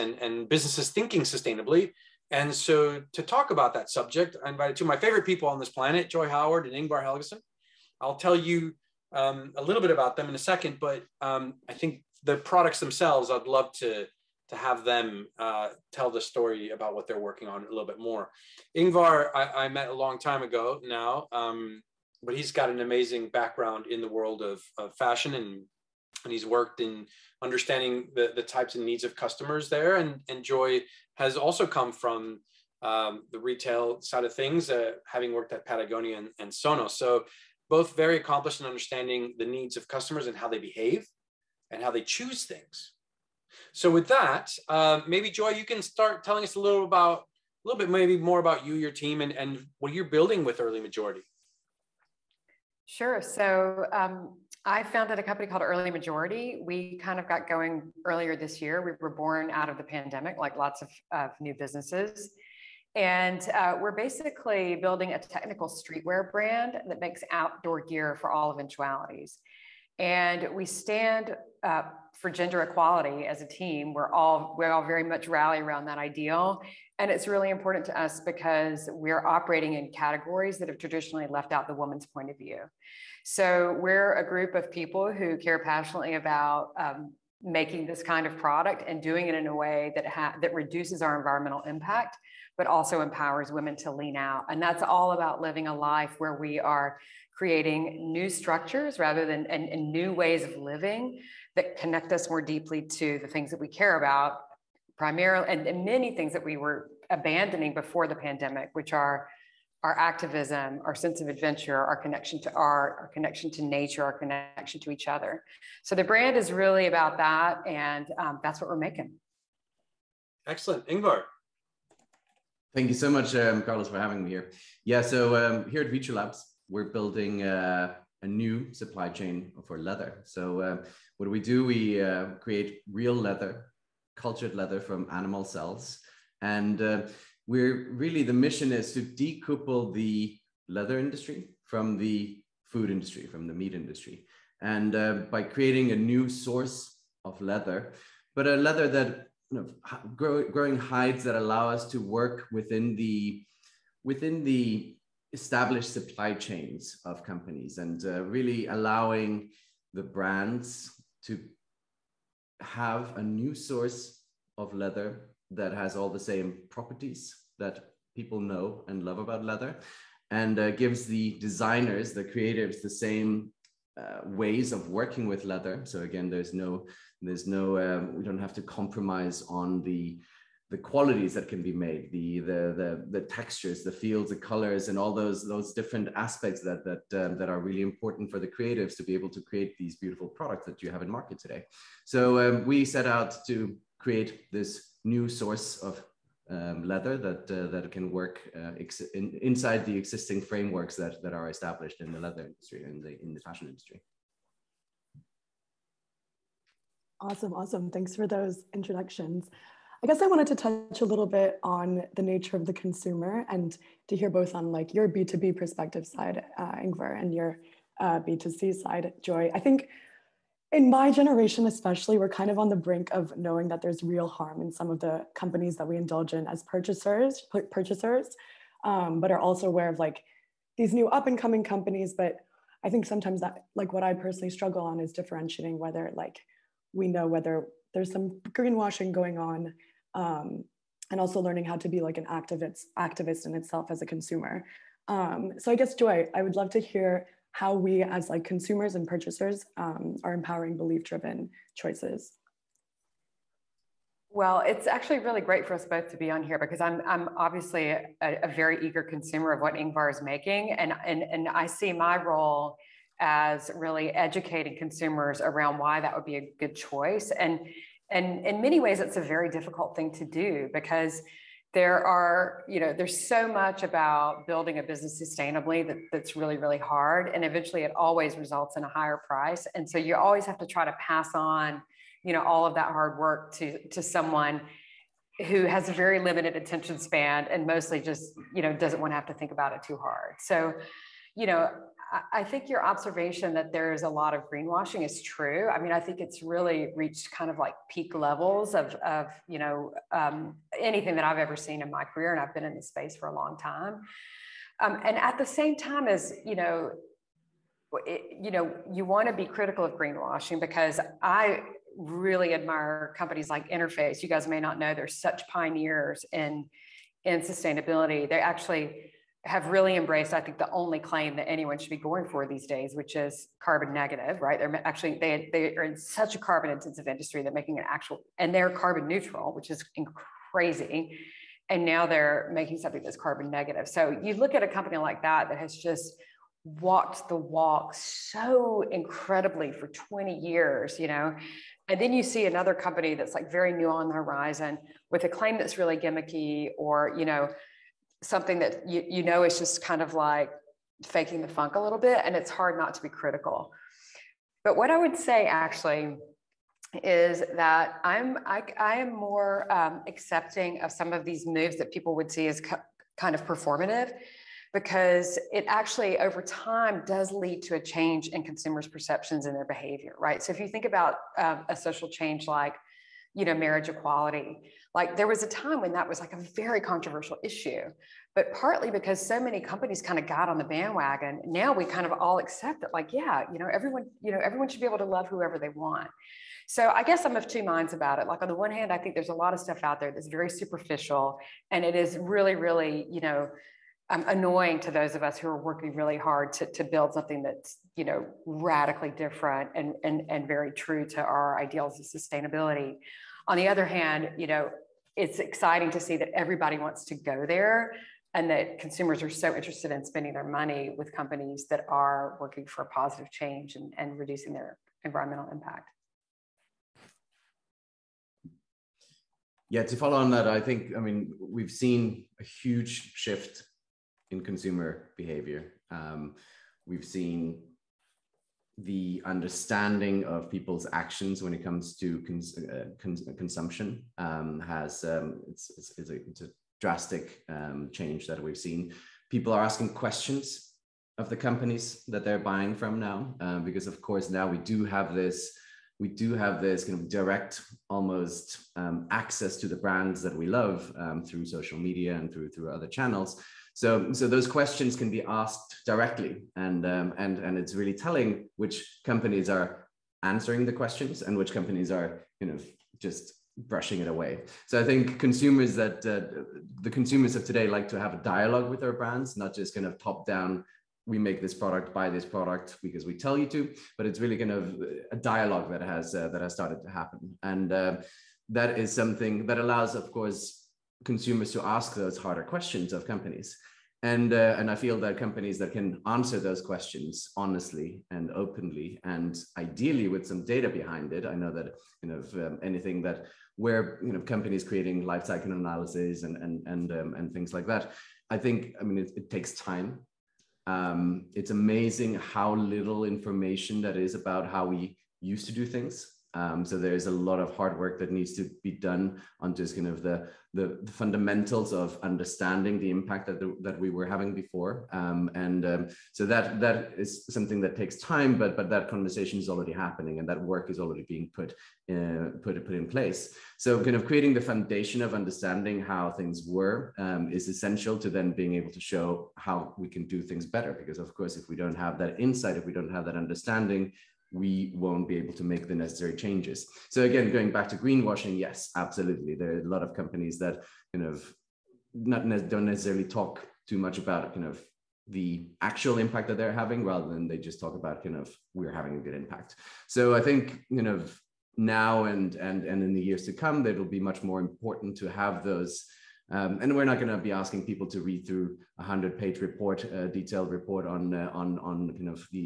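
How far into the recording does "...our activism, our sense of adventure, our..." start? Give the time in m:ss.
1:49.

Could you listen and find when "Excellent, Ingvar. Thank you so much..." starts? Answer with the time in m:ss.
2:00.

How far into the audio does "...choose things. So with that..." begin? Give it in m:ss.
0:42.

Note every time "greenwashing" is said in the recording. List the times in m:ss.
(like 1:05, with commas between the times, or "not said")
3:58, 4:54, 5:09, 8:57.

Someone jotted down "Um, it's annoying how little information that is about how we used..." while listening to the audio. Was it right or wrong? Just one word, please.
wrong.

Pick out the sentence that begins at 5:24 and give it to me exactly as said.
They're actually they they are in such a carbon intensive industry that making an actual and they're carbon neutral, which is crazy.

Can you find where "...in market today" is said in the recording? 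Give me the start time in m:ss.
3:11.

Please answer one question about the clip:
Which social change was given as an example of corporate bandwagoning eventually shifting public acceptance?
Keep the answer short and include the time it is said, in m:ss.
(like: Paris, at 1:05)
marriage equality, at 6:13.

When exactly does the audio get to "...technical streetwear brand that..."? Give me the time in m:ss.
1:05.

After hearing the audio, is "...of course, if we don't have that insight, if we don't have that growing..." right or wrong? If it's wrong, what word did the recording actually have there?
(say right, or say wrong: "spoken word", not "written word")
wrong: "understanding", not "growing".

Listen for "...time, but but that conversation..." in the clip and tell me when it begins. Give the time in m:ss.
8:37.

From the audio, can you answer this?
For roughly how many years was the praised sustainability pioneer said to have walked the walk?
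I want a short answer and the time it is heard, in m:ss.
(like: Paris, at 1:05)
20 years, at 5:39.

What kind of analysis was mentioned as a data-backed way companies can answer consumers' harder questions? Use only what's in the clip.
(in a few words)
life cycle analysis.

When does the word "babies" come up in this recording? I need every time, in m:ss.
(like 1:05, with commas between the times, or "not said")
not said.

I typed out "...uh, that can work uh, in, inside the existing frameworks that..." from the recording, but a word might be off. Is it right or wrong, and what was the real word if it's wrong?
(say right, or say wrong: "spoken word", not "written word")
right.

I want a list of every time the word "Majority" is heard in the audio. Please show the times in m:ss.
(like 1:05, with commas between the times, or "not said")
0:50, 0:55.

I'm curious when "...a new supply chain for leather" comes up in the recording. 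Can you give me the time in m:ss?
2:08.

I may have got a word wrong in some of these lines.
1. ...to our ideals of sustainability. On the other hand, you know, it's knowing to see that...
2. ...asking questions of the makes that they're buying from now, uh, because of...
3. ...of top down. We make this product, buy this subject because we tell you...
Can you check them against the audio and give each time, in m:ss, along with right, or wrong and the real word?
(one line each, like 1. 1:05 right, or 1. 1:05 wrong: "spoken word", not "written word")
1. 6:41 wrong: "exciting", not "knowing"
2. 7:19 wrong: "companies", not "makes"
3. 7:49 wrong: "product", not "subject".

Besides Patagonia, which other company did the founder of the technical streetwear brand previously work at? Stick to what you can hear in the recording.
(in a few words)
Sonos.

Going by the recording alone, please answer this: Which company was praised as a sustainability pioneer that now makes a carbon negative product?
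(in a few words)
Interface.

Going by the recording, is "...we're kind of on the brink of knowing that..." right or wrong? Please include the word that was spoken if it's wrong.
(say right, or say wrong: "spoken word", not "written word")
right.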